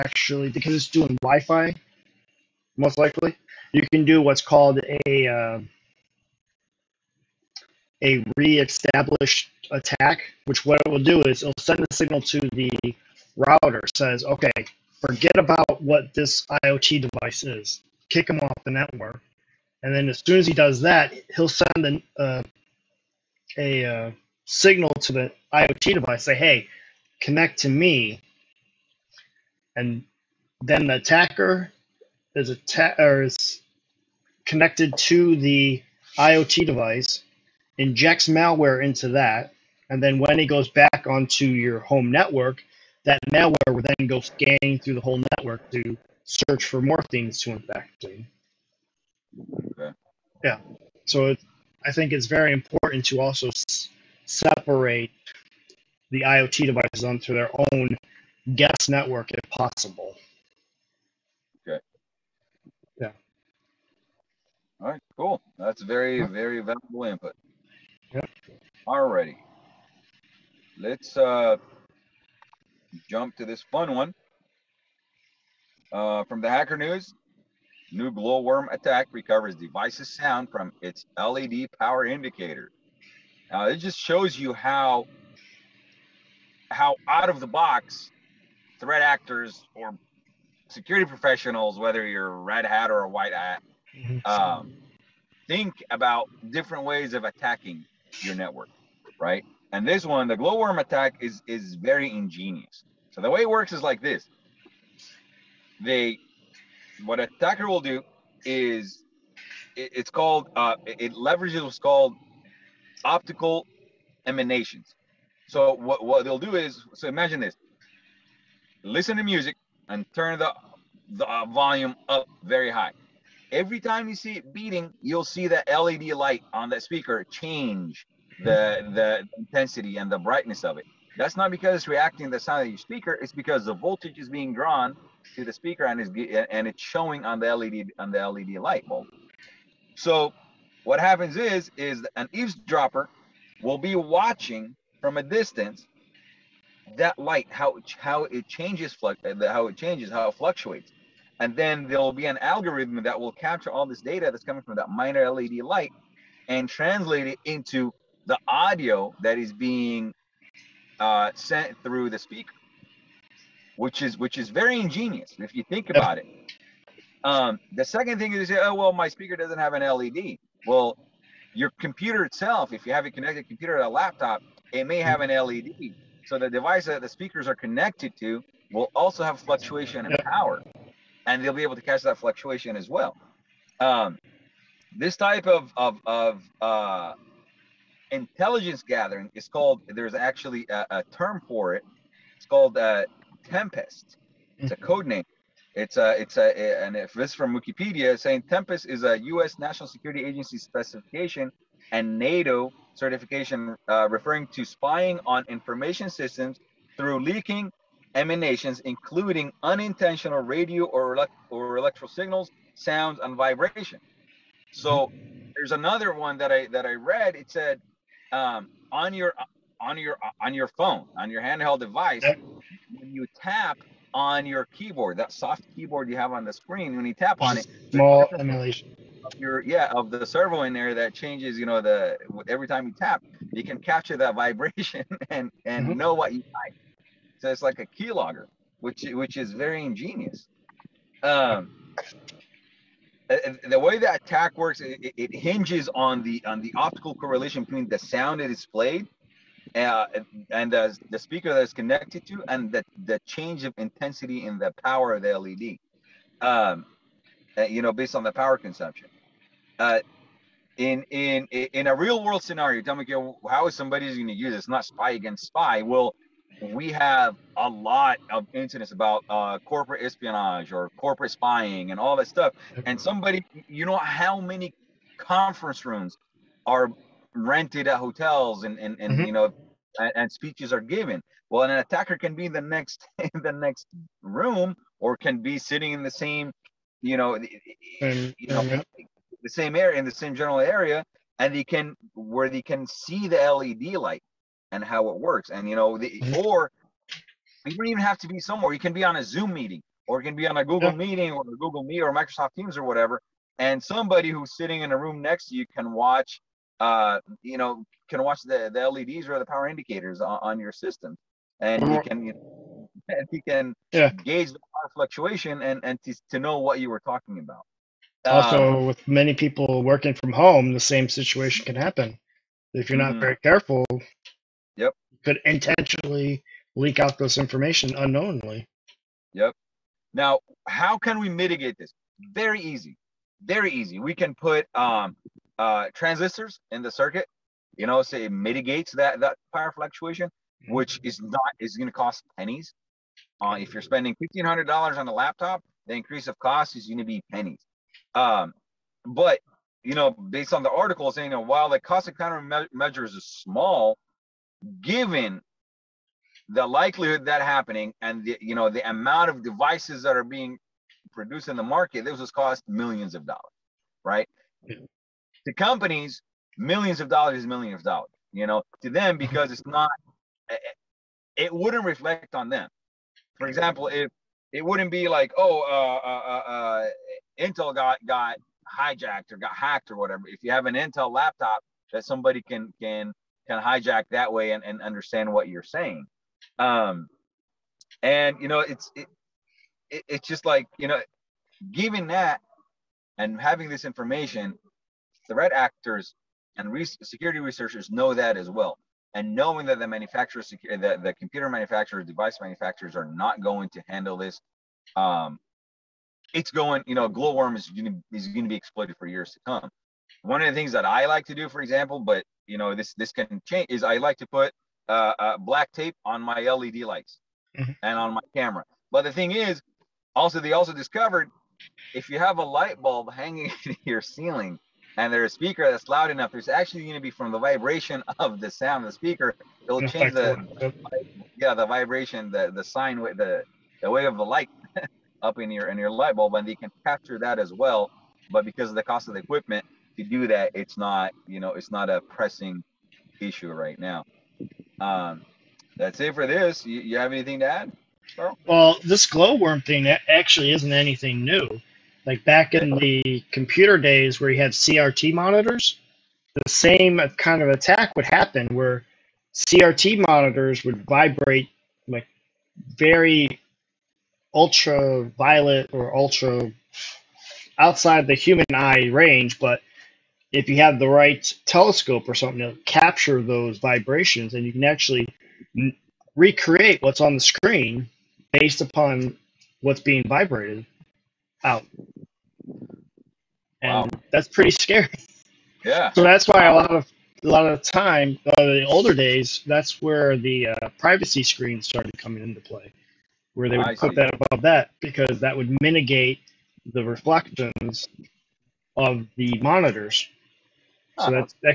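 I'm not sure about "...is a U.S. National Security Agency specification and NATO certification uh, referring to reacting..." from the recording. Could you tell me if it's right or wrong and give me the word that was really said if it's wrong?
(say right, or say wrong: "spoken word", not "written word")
wrong: "spying", not "reacting".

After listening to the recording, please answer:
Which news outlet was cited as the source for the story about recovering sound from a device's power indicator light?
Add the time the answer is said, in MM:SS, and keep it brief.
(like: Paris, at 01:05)
The Hacker News, at 01:16.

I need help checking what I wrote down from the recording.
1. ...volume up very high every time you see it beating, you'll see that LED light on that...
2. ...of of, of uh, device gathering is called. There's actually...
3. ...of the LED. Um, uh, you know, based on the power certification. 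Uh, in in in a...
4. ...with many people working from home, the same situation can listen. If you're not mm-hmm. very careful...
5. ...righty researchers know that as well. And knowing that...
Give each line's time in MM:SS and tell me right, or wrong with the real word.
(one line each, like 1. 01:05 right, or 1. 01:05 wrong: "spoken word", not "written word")
1. 02:01 right
2. 03:05 wrong: "intelligence", not "device"
3. 04:15 wrong: "consumption", not "certification"
4. 05:18 wrong: "happen", not "listen"
5. 06:37 wrong: "security", not "righty".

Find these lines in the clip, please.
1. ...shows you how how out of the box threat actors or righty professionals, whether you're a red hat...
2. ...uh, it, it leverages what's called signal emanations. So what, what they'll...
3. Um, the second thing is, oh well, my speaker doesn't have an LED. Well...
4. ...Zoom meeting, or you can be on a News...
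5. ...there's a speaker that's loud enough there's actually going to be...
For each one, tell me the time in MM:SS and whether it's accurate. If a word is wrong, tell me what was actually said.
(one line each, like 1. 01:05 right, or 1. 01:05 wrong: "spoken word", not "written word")
1. 01:23 wrong: "security", not "righty"
2. 01:50 wrong: "optical", not "signal"
3. 02:47 right
4. 04:59 wrong: "Google", not "News"
5. 07:05 right.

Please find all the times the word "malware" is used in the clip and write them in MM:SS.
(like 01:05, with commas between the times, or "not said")
00:38, 00:43.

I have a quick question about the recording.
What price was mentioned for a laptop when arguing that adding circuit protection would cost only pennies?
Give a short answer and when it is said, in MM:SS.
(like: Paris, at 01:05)
$1500, at 05:44.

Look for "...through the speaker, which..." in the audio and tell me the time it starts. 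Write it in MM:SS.
02:41.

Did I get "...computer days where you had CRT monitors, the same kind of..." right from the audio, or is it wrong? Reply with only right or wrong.
right.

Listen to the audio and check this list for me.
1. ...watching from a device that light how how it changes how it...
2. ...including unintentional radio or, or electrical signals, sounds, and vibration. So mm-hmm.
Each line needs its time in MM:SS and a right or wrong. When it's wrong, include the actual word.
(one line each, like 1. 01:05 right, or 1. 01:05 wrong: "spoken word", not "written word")
1. 02:23 wrong: "distance", not "device"
2. 03:28 right.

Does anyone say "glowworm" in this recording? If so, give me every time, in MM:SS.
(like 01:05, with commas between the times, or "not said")
01:18, 01:40, 06:47, 07:29.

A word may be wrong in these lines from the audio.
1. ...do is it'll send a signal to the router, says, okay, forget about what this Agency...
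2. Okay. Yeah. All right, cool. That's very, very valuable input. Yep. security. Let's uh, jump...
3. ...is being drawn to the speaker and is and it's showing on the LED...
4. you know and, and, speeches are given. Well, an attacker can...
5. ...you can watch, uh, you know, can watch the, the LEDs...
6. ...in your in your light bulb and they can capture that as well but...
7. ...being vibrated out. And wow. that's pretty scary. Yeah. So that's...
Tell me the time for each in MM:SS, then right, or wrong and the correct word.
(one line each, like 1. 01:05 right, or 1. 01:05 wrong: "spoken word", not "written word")
1. 00:11 wrong: "IoT", not "Agency"
2. 01:01 wrong: "righty", not "security"
3. 02:14 right
4. 04:39 right
5. 05:05 right
6. 07:15 right
7. 07:59 right.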